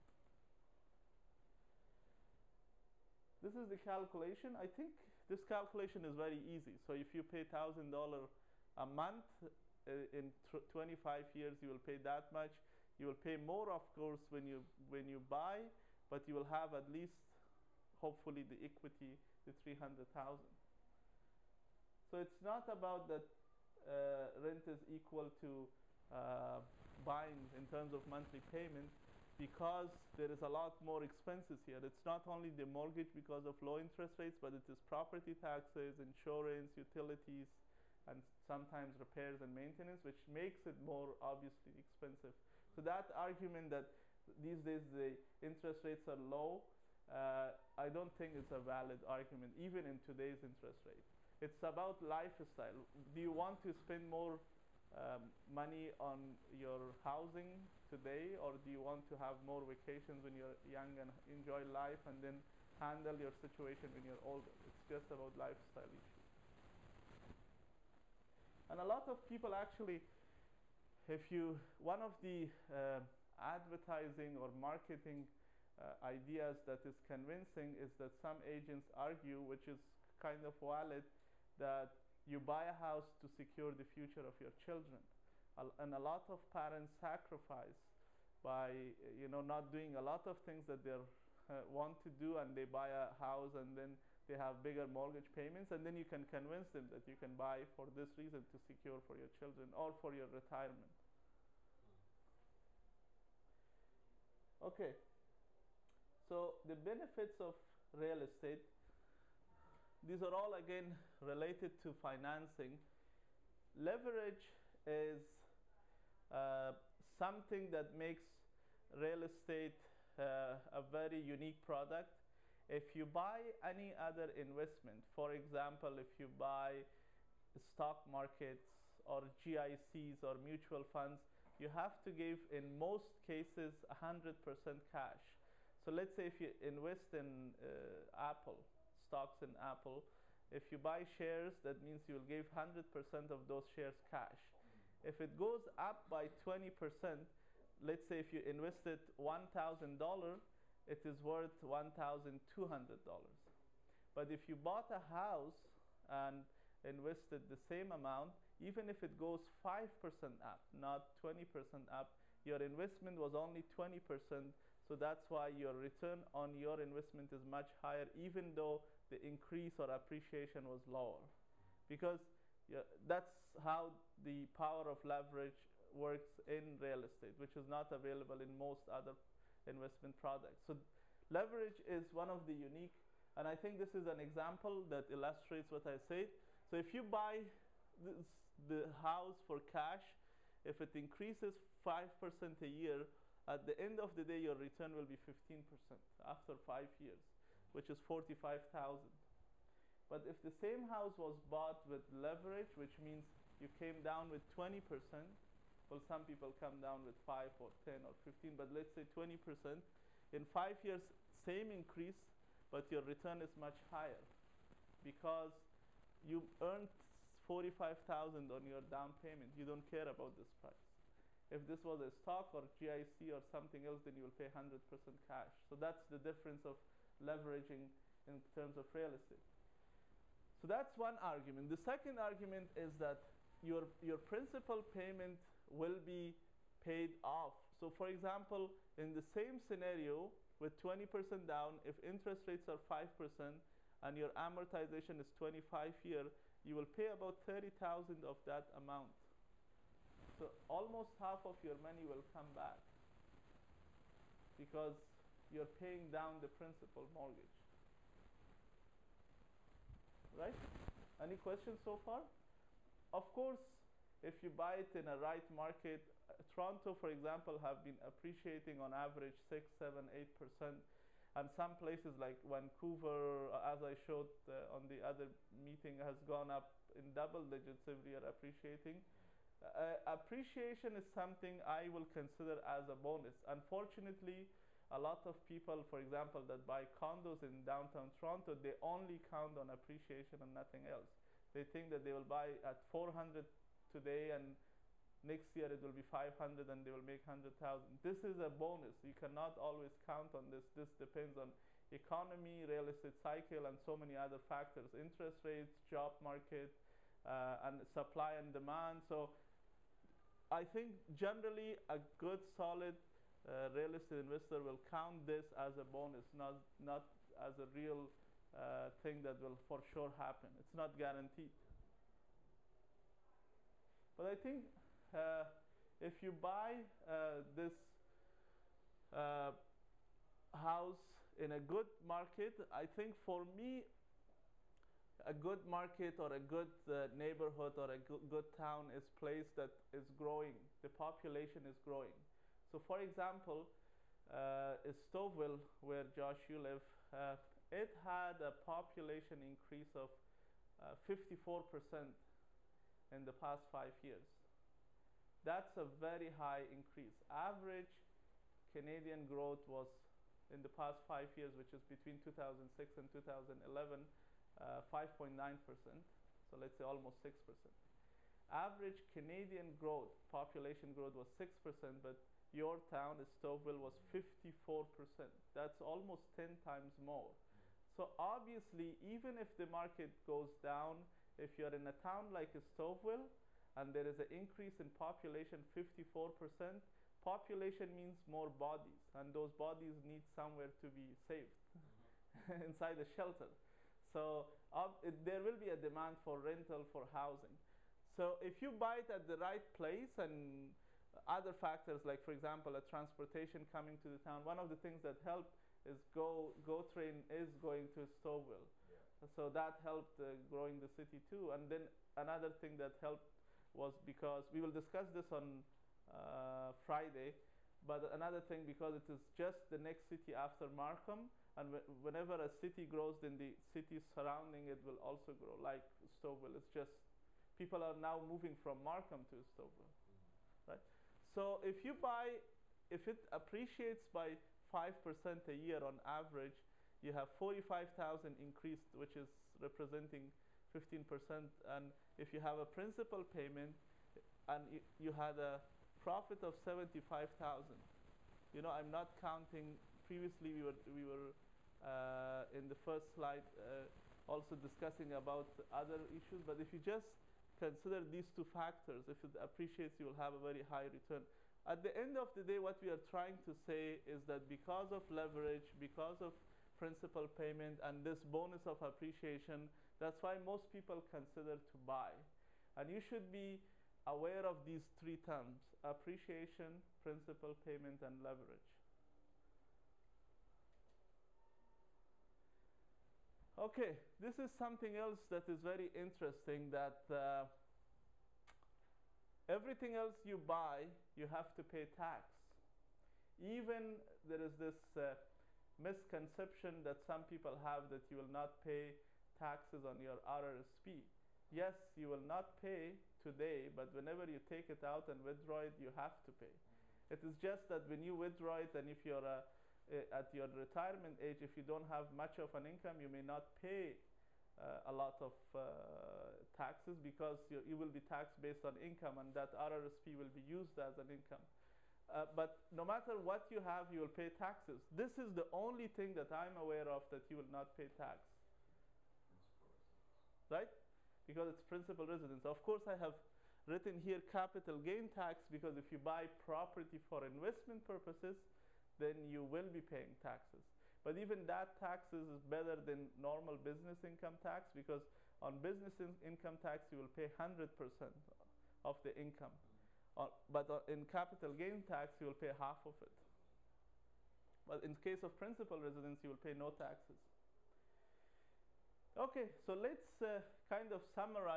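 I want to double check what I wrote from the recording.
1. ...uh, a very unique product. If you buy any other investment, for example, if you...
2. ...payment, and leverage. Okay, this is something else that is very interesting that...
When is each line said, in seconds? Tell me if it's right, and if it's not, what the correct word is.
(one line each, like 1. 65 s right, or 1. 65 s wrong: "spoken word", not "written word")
1. 120 s right
2. 477 s right.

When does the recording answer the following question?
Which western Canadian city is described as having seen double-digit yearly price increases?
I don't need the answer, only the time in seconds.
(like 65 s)
272 s.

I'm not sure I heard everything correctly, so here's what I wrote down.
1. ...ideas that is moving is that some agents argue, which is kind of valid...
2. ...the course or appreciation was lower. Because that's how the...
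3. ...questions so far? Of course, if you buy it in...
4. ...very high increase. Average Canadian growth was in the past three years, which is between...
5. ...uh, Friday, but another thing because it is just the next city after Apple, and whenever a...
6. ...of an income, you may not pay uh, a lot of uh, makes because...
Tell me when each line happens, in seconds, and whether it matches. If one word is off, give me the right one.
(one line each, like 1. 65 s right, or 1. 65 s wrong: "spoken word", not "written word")
1. 76 s wrong: "convincing", not "moving"
2. 169 s wrong: "increase", not "course"
3. 261 s right
4. 355 s wrong: "five", not "three"
5. 416 s wrong: "Markham", not "Apple"
6. 512 s wrong: "taxes", not "makes".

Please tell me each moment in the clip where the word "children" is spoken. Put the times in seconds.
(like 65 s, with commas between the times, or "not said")
84 s, 99 s.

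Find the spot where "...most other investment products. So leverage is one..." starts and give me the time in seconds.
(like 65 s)
178 s.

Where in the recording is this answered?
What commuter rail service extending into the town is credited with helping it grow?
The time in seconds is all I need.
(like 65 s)
406 s.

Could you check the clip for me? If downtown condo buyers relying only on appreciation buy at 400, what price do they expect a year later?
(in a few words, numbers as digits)
500.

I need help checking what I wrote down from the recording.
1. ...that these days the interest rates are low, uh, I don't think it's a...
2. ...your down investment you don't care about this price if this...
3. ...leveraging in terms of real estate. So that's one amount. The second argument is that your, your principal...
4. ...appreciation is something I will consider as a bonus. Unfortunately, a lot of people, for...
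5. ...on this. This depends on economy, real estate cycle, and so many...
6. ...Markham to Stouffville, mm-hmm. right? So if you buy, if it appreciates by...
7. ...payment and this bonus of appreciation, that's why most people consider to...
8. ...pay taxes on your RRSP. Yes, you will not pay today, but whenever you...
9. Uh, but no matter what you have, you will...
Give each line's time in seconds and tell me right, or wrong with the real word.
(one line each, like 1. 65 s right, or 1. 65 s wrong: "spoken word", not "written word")
1. 43 s right
2. 218 s wrong: "payment", not "investment"
3. 227 s wrong: "argument", not "amount"
4. 280 s right
5. 300 s right
6. 428 s right
7. 467 s right
8. 498 s right
9. 522 s right.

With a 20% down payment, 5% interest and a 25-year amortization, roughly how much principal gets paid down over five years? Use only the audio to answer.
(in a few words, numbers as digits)
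30,000.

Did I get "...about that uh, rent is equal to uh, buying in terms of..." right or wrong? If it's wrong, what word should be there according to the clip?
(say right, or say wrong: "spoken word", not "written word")
right.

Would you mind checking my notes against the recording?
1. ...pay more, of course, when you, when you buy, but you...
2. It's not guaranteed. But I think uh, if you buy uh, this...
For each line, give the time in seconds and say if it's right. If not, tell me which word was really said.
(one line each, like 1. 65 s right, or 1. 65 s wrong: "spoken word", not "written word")
1. 13 s right
2. 320 s right.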